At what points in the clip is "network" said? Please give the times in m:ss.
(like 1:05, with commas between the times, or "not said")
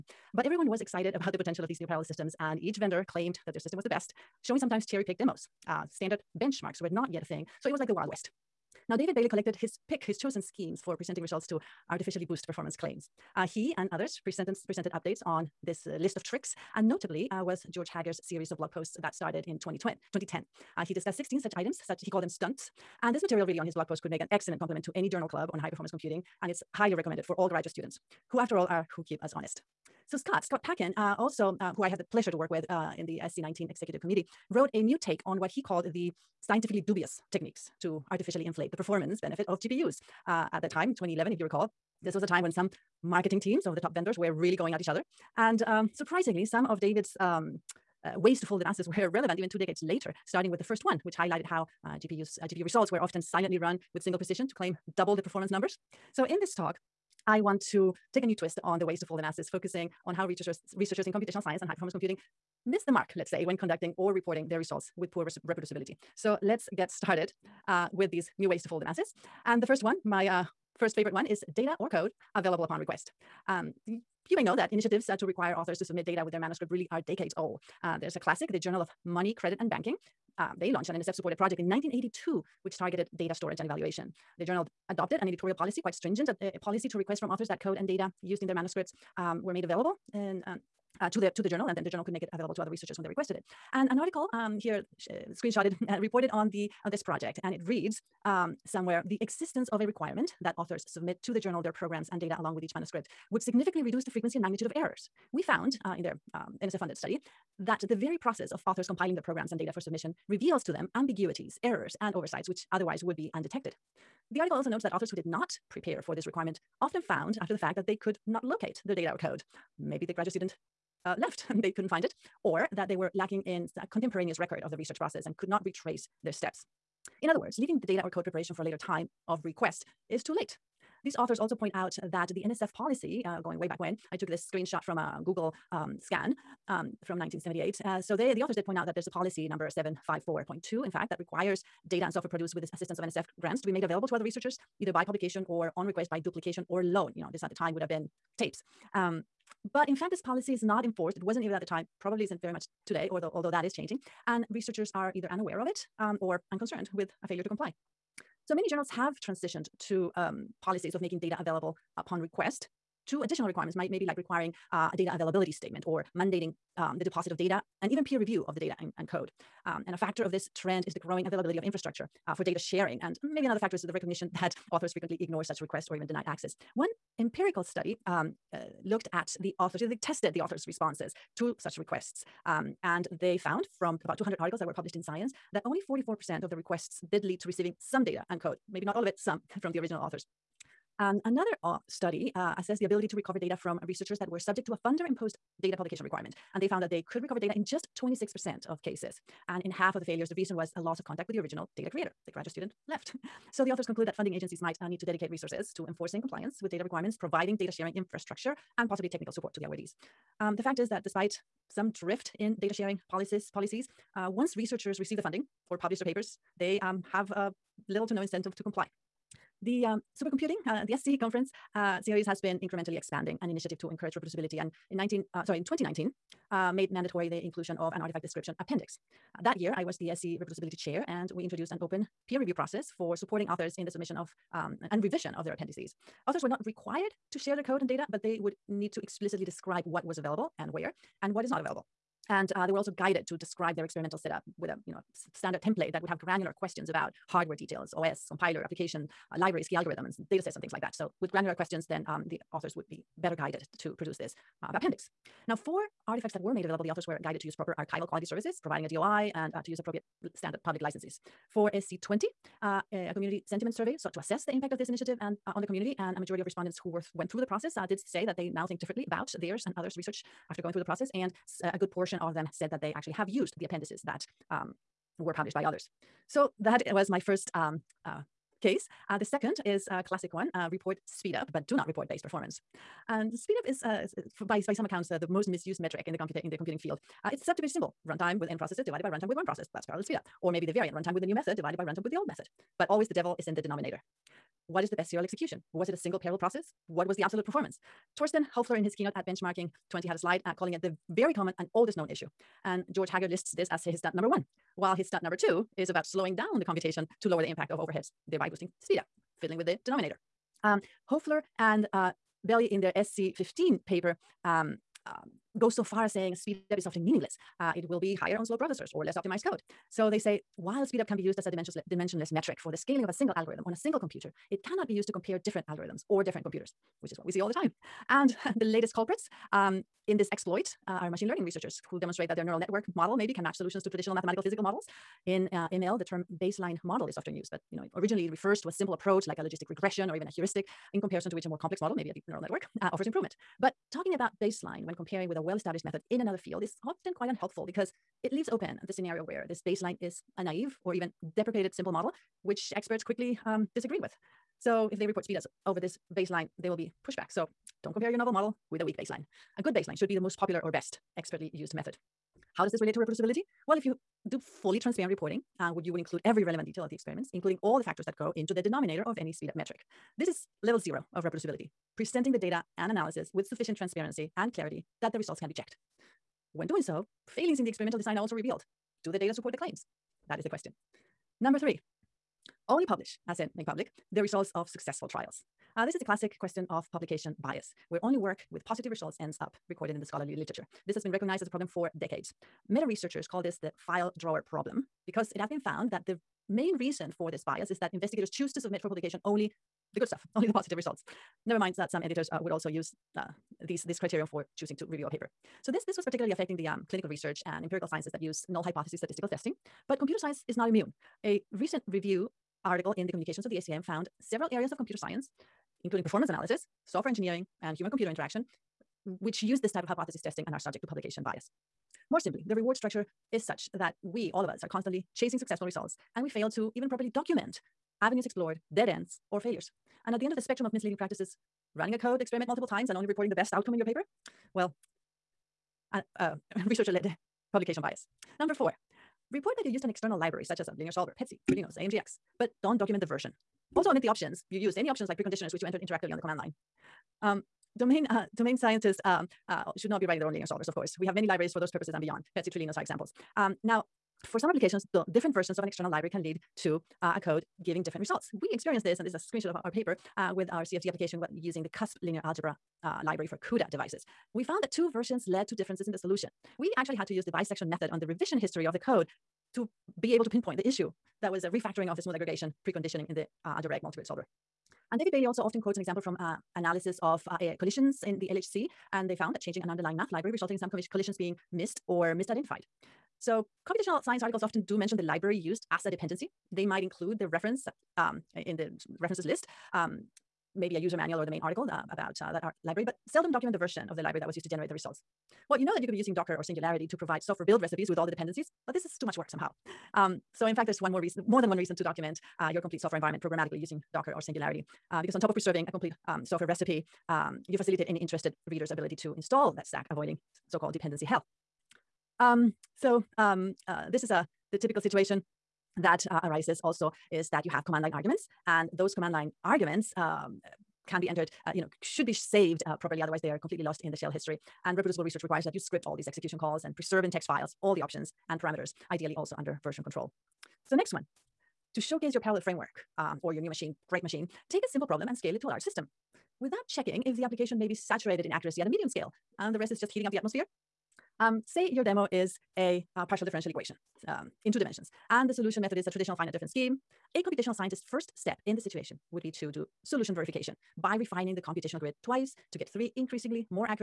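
5:32, 5:42.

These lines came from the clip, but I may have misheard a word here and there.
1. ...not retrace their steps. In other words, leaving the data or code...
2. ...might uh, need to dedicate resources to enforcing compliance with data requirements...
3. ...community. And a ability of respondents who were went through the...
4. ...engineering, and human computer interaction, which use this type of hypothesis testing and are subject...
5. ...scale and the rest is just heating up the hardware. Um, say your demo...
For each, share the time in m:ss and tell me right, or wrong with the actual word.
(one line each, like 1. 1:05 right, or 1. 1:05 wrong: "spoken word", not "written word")
1. 2:05 right
2. 3:24 right
3. 4:25 wrong: "majority", not "ability"
4. 6:57 right
5. 8:58 wrong: "atmosphere", not "hardware".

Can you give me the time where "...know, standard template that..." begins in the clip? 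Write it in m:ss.
4:04.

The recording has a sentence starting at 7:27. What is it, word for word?
Um, domain, uh, domain scientists um, uh, should not be writing their own linear solvers, of course.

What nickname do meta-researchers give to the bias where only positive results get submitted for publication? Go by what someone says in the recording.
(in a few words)
file drawer problem.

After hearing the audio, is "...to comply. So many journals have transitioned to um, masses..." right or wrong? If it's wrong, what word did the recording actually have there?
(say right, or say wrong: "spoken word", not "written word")
wrong: "policies", not "masses".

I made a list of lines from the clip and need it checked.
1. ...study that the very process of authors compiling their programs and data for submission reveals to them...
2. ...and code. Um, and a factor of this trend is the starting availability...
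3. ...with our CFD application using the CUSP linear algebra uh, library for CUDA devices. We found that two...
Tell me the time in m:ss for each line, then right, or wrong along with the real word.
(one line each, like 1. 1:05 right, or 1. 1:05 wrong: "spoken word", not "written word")
1. 1:46 right
2. 2:48 wrong: "growing", not "starting"
3. 7:40 right.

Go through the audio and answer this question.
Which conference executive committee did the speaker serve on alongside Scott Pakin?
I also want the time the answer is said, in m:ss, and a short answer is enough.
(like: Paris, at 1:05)
SC19, at 0:33.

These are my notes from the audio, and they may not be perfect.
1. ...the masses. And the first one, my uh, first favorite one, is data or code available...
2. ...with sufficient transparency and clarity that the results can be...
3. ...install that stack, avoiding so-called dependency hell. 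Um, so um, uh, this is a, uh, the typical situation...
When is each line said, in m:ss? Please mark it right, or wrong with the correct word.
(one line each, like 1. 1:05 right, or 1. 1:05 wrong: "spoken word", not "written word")
1. 1:08 right
2. 6:13 right
3. 8:29 right.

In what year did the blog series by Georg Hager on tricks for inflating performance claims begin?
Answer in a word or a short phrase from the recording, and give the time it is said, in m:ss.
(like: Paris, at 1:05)
2010, at 0:19.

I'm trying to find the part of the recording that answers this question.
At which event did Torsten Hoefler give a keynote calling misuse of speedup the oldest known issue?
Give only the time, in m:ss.
4:59.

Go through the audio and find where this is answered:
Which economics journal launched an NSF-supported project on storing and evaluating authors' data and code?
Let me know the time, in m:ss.
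1:18.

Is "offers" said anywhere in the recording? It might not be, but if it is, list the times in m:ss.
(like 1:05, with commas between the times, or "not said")
5:42.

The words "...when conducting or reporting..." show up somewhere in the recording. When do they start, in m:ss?
1:03.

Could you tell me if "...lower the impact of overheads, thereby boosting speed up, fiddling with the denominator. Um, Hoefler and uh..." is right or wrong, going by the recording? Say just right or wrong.
right.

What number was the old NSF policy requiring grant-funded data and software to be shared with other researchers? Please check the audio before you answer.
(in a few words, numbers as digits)
754.2.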